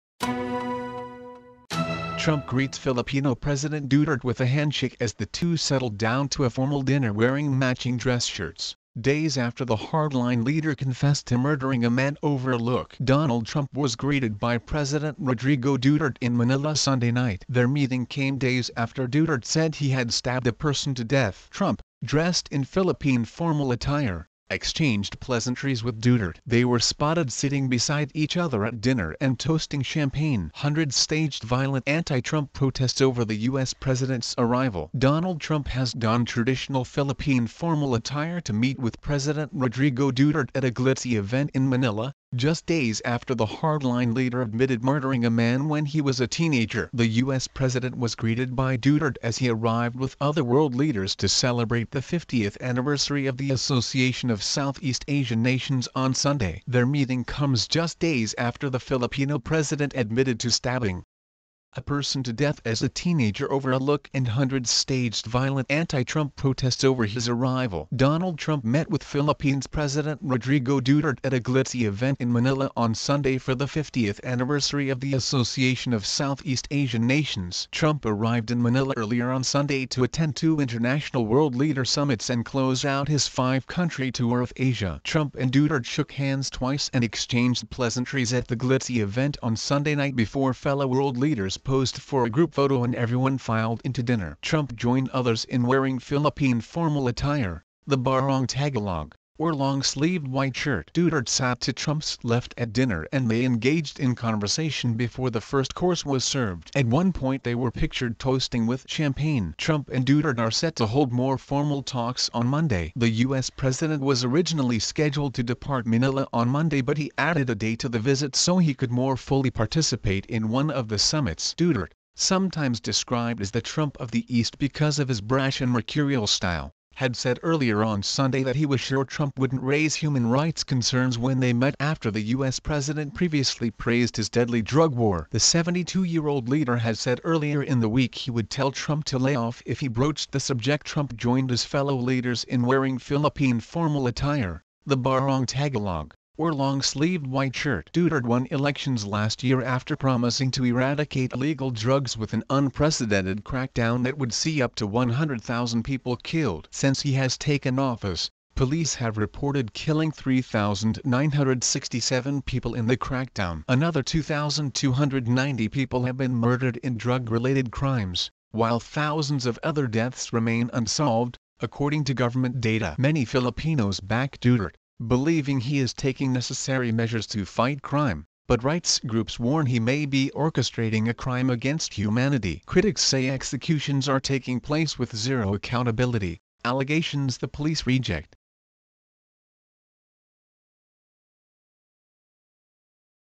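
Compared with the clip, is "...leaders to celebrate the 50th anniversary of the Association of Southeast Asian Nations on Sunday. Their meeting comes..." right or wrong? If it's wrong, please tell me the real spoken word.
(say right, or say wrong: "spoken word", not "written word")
right.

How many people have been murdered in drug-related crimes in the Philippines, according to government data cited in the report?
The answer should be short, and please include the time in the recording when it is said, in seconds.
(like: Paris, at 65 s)
2,290, at 164 s.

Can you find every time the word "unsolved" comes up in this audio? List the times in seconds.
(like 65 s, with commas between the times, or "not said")
170 s.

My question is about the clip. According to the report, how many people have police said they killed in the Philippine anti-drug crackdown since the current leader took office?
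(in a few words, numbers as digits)
3,967.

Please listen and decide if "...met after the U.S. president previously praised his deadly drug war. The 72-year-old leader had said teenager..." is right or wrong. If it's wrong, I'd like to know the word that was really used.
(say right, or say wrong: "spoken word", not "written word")
wrong: "earlier", not "teenager".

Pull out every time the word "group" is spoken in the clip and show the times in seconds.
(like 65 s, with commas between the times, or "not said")
92 s, 178 s.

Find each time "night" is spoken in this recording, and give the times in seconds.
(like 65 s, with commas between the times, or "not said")
17 s, 89 s.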